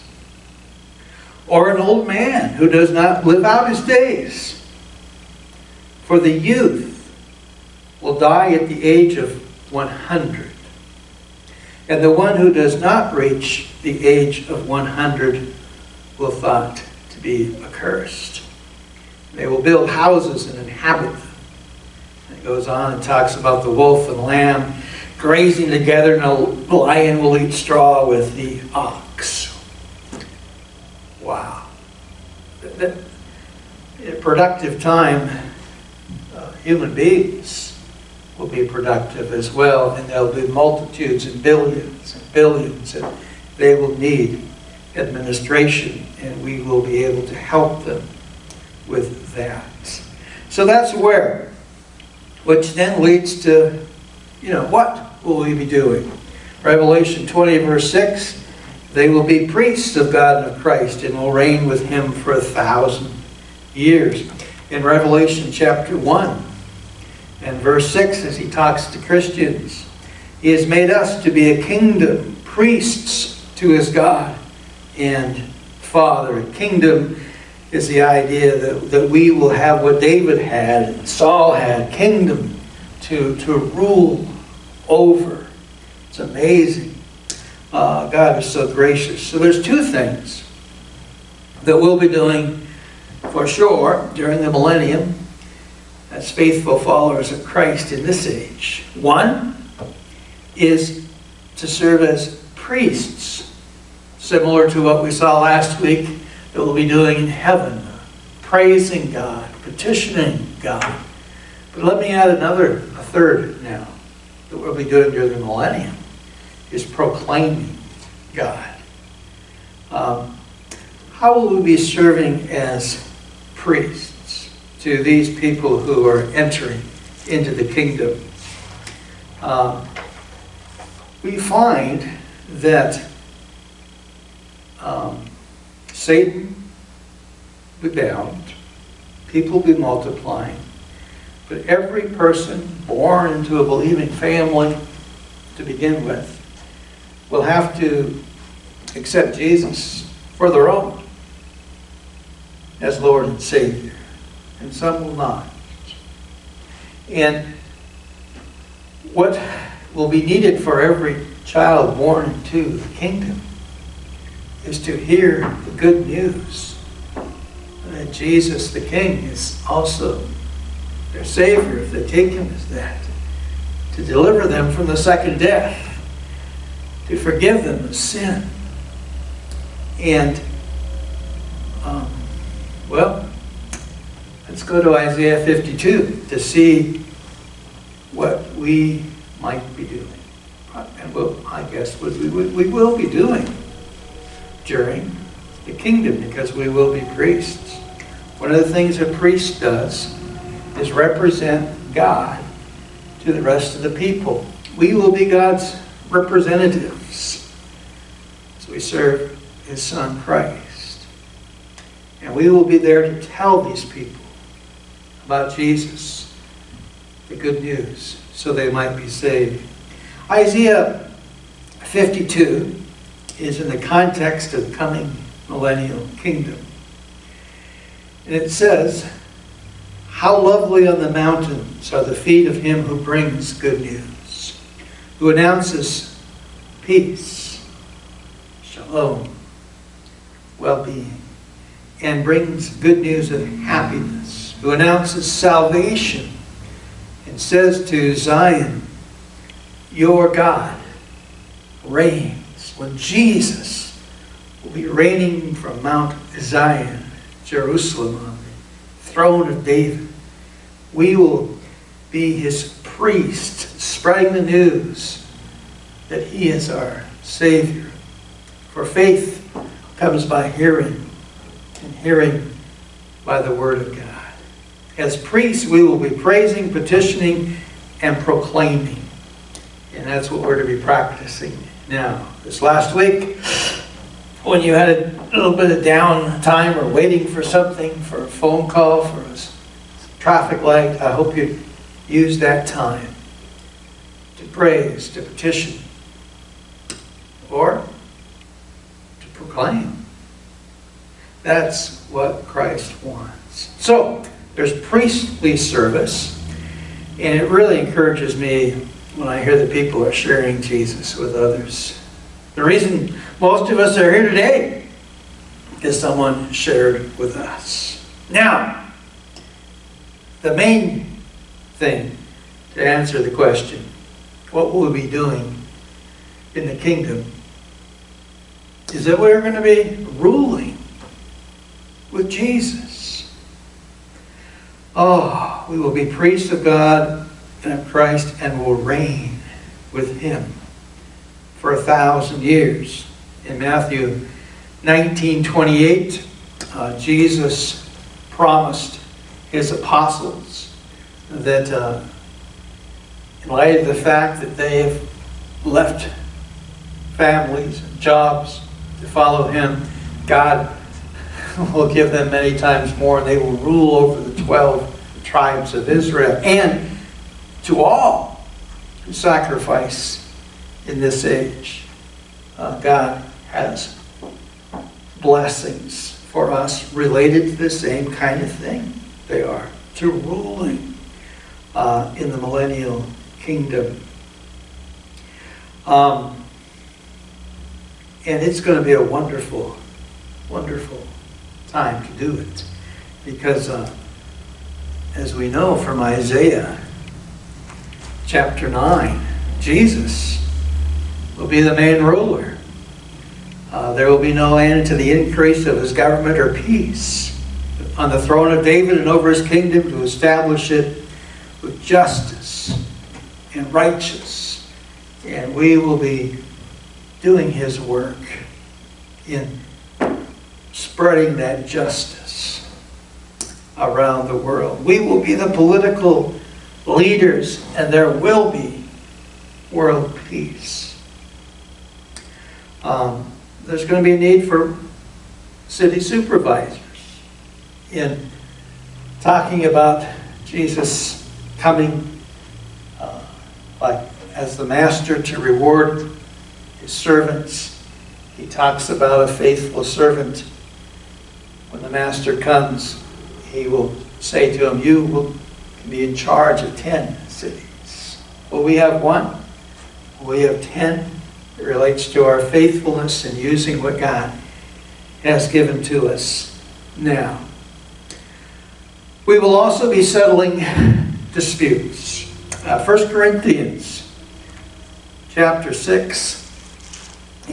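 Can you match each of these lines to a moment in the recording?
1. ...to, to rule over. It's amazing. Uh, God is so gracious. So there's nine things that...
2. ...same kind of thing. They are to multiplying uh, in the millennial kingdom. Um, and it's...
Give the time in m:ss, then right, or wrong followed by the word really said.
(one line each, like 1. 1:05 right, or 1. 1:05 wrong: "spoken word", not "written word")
1. 1:23 wrong: "two", not "nine"
2. 6:17 wrong: "ruling", not "multiplying".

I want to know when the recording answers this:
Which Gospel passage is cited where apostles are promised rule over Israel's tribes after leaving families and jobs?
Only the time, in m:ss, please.
5:43.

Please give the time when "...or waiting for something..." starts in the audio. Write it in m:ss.
4:46.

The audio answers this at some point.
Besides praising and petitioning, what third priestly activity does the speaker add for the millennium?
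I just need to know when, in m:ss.
1:56.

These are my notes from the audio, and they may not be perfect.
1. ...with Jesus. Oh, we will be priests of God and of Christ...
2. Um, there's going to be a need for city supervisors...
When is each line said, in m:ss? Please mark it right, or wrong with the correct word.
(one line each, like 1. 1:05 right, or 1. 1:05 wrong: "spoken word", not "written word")
1. 5:32 right
2. 7:12 right.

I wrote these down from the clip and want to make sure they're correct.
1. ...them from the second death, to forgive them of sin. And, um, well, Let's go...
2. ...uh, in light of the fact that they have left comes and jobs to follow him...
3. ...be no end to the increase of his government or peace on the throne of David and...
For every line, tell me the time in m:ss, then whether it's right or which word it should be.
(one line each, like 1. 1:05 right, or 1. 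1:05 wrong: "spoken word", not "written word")
1. 2:54 right
2. 5:51 wrong: "families", not "comes"
3. 6:44 right.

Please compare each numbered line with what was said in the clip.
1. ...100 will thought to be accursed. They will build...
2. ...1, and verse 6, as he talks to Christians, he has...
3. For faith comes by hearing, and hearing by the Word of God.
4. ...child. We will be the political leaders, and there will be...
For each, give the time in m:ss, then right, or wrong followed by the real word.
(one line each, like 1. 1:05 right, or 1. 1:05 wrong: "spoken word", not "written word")
1. 0:14 right
2. 1:05 right
3. 4:28 right
4. 7:04 wrong: "world", not "child".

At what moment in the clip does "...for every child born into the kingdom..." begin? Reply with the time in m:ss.
2:40.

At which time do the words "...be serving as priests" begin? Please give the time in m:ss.
2:01.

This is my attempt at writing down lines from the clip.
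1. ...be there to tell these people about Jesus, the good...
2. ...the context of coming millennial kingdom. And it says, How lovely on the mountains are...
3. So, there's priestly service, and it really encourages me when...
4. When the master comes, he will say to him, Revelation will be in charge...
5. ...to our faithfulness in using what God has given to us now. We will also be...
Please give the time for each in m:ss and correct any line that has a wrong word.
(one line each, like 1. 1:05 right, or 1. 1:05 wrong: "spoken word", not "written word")
1. 3:32 right
2. 3:43 right
3. 5:03 right
4. 7:31 wrong: "You", not "Revelation"
5. 7:42 right.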